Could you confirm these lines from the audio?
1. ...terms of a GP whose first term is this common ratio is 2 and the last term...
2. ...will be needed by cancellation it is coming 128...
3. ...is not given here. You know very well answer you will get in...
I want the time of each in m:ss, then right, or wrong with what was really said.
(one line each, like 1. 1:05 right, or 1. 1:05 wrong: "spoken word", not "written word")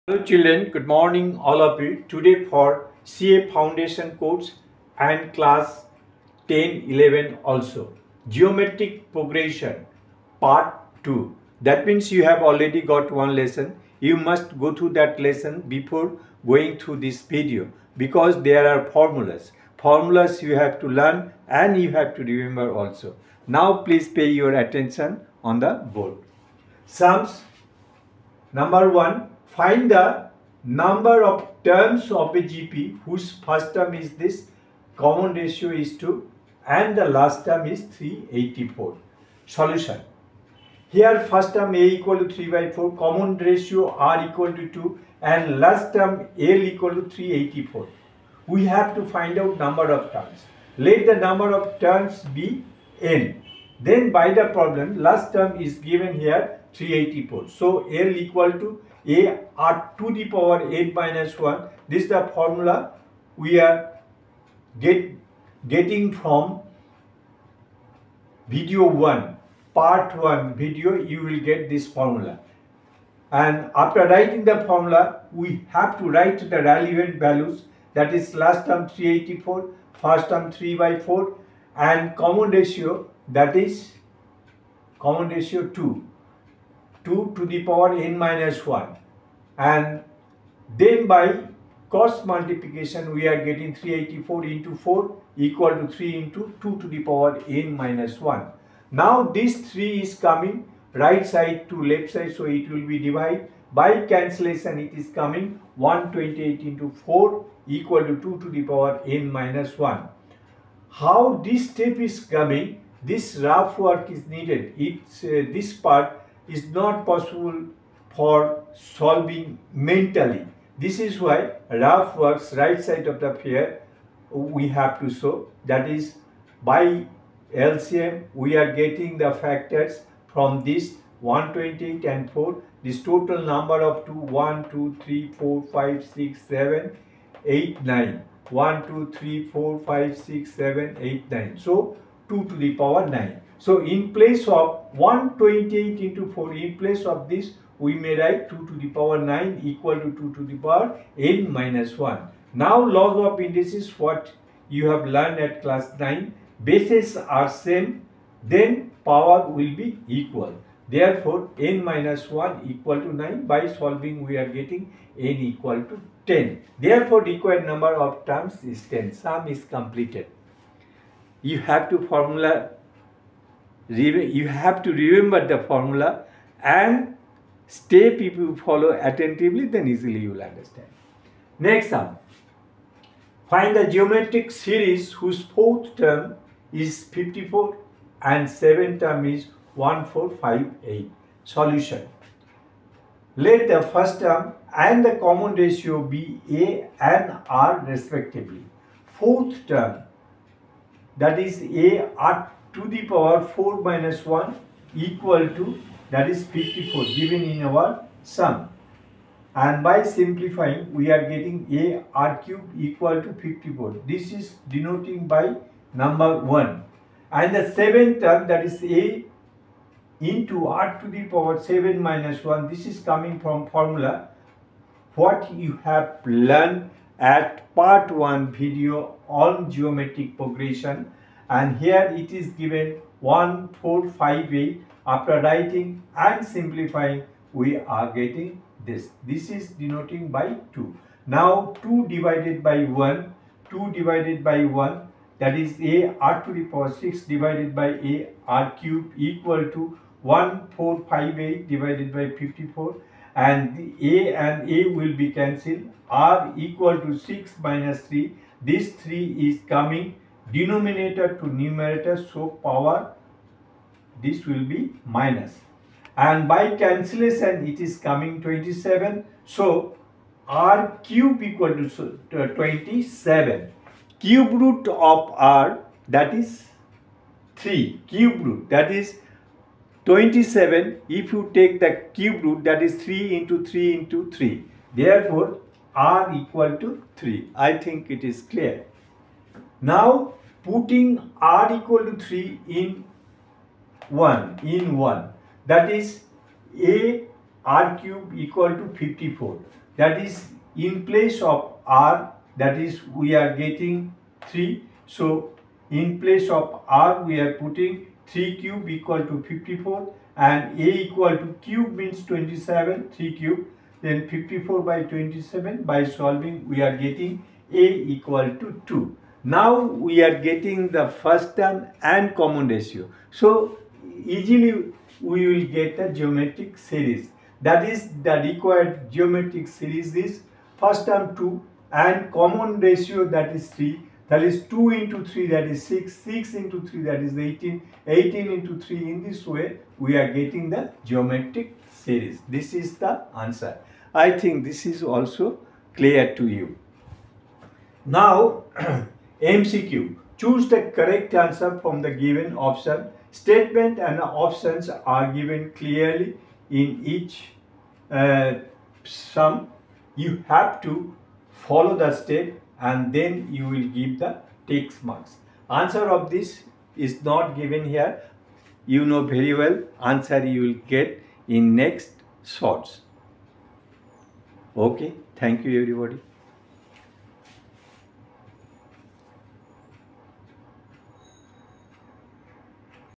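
1. 0:31 right
2. 1:42 wrong: "divided", not "needed"
3. 6:06 right.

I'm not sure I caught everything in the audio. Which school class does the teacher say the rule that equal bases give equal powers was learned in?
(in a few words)
Class 9.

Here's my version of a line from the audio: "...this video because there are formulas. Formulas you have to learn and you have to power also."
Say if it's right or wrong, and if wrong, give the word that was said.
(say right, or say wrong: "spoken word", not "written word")
wrong: "remember", not "power".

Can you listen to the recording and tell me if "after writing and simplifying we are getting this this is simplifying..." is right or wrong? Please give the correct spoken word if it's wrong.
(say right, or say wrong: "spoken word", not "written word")
wrong: "denoting", not "simplifying".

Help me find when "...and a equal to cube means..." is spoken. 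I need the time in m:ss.
5:10.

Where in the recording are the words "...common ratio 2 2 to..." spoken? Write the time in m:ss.
1:24.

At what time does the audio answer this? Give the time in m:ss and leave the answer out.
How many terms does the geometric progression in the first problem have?
2:45.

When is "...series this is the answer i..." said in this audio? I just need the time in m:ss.
5:41.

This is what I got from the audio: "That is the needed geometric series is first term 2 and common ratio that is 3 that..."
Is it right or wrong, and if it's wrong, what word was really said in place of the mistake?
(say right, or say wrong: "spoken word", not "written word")
wrong: "required", not "needed".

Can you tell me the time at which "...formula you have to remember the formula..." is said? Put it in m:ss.
2:52.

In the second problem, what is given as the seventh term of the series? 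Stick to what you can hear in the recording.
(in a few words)
1458.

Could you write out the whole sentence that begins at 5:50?
Choose the correct answer from the given option.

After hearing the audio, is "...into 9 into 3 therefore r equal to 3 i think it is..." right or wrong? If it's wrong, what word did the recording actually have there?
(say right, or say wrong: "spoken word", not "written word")
wrong: "3", not "9".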